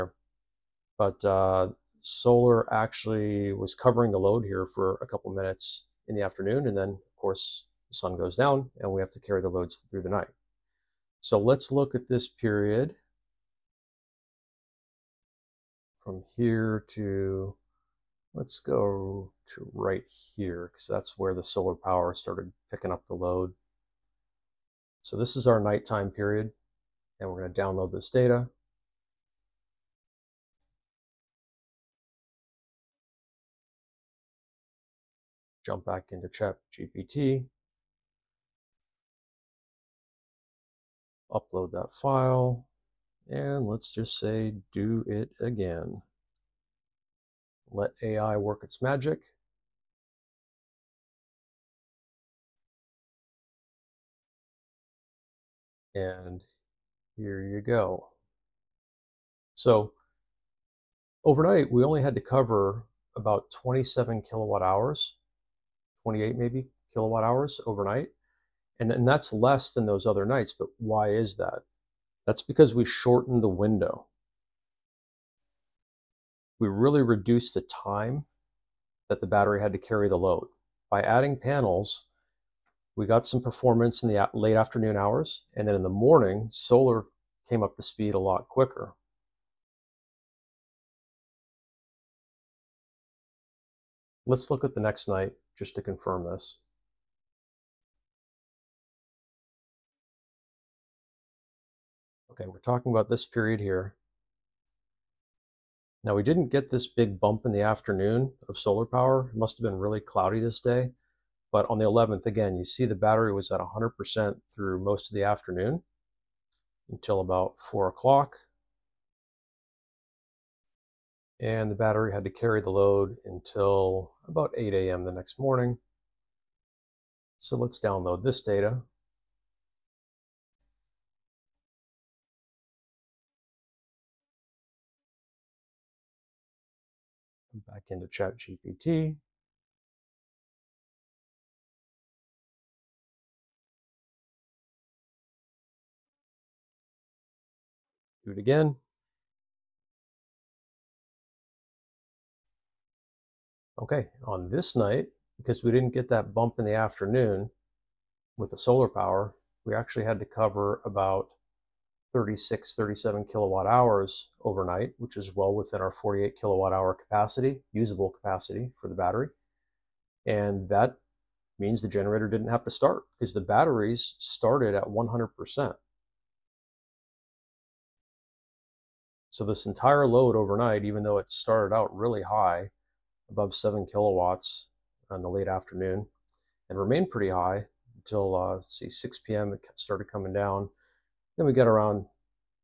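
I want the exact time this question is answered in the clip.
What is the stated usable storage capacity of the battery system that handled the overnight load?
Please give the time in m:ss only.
2:45.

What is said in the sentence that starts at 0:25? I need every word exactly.
So this is our nighttime period, and we're going to download this data.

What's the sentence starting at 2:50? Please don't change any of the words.
And that means the generator didn't have to start because the batteries started at 100%.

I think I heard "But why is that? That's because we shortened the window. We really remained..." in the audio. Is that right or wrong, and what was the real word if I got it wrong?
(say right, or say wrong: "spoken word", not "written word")
wrong: "reduced", not "remained".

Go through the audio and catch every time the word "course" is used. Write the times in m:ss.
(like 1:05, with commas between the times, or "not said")
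0:07.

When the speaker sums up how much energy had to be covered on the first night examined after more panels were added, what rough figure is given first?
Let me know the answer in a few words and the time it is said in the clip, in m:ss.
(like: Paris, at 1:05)
27 kilowatt hours, at 1:03.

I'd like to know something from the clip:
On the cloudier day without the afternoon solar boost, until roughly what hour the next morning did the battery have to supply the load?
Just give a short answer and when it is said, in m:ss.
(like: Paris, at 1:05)
8 a.m., at 2:04.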